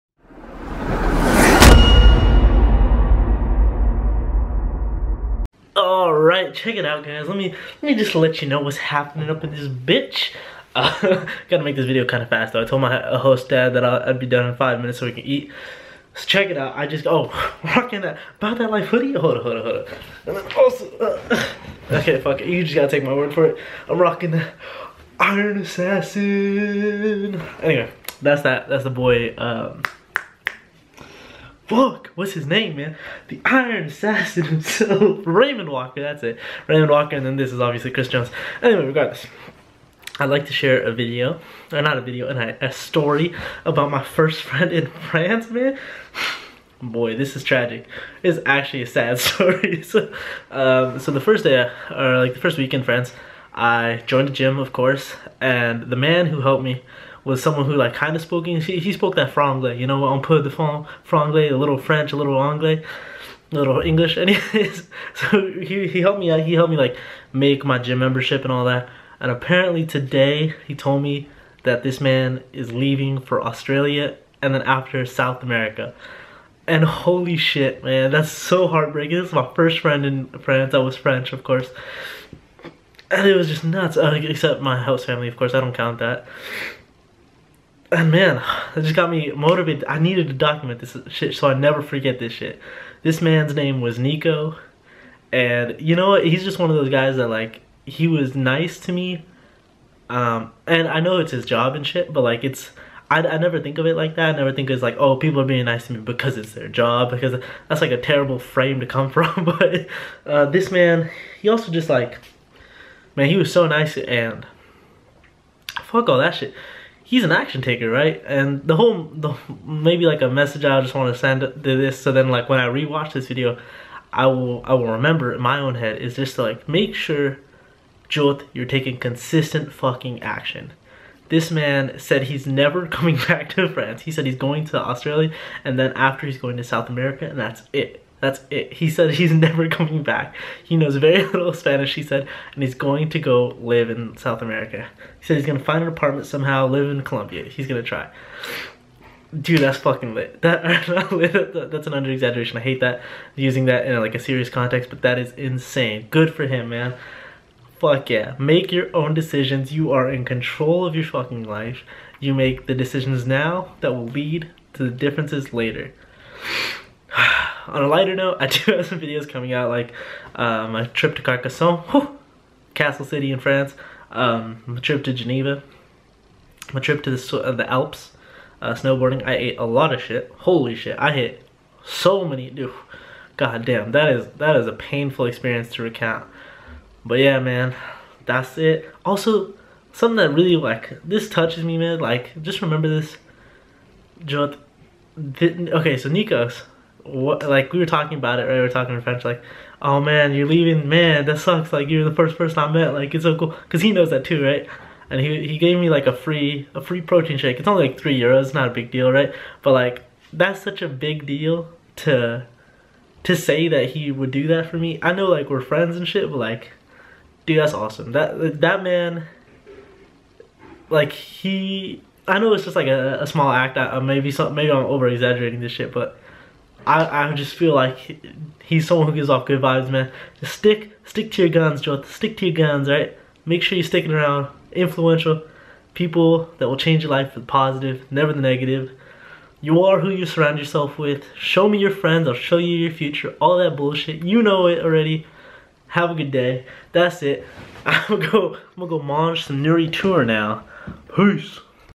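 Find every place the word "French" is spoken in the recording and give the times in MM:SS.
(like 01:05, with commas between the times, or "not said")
01:01, 01:20, 03:19.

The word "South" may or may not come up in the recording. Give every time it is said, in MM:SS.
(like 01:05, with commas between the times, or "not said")
01:15, 02:16, 02:24.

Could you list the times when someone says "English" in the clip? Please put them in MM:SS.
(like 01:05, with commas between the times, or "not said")
00:58, 01:03.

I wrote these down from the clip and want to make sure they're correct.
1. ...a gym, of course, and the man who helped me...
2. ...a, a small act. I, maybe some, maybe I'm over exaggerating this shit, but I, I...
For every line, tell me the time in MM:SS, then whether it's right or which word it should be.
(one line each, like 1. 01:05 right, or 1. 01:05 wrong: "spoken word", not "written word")
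1. 00:54 right
2. 03:42 right.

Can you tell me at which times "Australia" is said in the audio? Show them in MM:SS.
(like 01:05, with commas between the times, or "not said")
01:13, 02:14.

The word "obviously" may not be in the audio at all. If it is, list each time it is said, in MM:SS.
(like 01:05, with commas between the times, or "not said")
00:37.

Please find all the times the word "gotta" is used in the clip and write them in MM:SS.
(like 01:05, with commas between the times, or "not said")
00:11, 00:22.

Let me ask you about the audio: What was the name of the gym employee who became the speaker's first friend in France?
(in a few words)
Nico.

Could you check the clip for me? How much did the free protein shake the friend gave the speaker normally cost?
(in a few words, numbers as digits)
3 euros.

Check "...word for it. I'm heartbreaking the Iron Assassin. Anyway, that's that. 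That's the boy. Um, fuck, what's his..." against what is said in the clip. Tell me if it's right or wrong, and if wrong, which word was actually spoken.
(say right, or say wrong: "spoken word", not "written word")
wrong: "rocking", not "heartbreaking".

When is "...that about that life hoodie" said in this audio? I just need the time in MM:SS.
00:17.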